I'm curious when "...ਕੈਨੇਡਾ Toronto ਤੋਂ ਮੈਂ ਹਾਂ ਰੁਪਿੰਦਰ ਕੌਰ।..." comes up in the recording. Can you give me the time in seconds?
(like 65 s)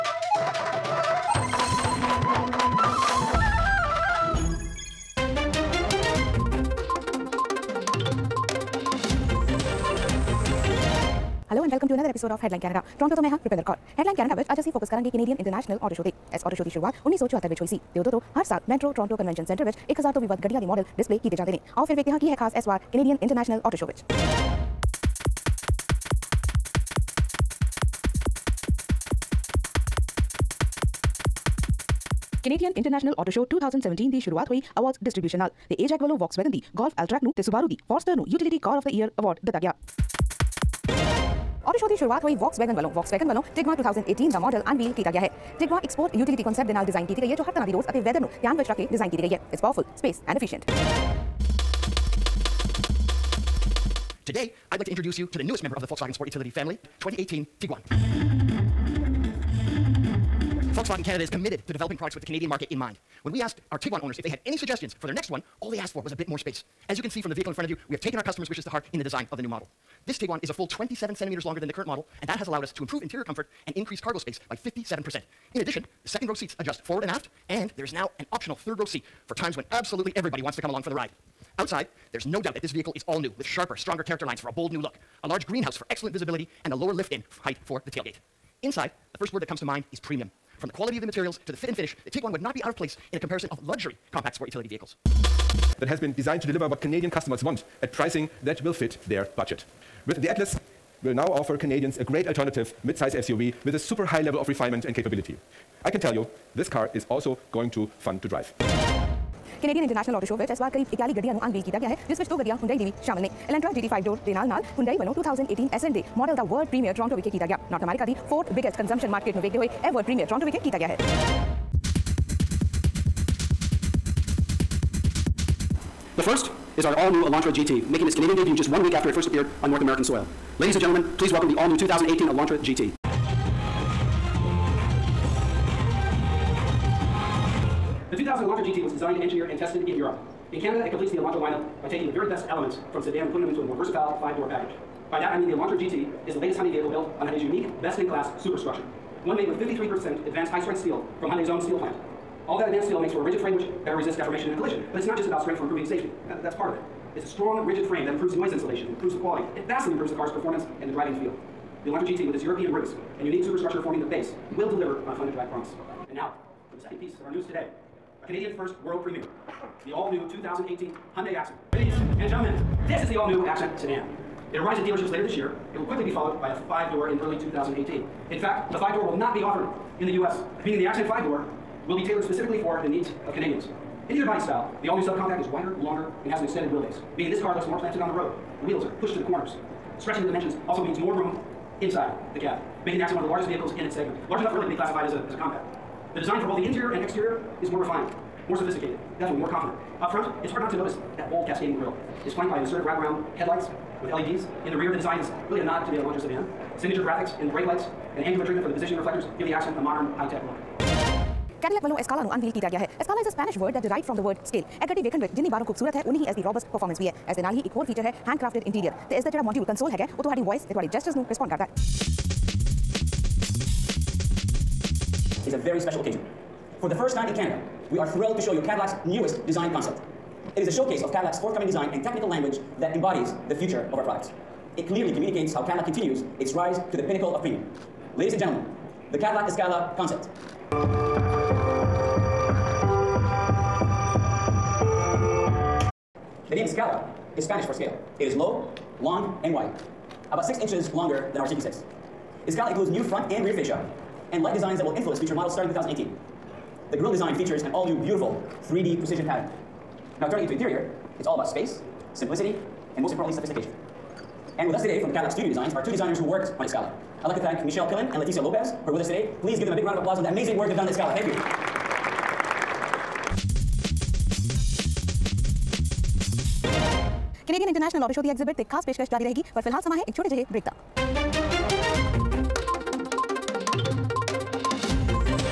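12 s.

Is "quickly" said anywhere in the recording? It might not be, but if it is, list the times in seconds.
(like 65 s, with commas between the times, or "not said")
175 s.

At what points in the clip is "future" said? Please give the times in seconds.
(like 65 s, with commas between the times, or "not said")
233 s, 255 s.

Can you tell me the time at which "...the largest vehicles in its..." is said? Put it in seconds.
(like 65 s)
193 s.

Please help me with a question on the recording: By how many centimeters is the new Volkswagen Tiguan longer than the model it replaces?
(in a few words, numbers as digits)
27 centimeters.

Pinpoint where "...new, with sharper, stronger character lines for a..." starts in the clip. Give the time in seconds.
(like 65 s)
83 s.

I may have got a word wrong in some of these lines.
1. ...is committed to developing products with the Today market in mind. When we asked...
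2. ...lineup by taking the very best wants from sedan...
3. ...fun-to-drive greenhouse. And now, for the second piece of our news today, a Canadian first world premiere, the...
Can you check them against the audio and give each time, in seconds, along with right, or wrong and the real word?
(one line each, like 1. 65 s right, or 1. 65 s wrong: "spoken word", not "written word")
1. 61 s wrong: "Canadian", not "Today"
2. 141 s wrong: "elements", not "wants"
3. 165 s wrong: "promise", not "greenhouse".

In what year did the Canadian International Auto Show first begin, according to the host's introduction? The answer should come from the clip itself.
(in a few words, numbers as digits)
1974.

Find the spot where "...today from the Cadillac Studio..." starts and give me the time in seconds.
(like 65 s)
264 s.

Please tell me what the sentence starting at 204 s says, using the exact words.
In the rear, the design is really a nod to the Elantra sedan.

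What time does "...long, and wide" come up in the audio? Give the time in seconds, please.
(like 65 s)
249 s.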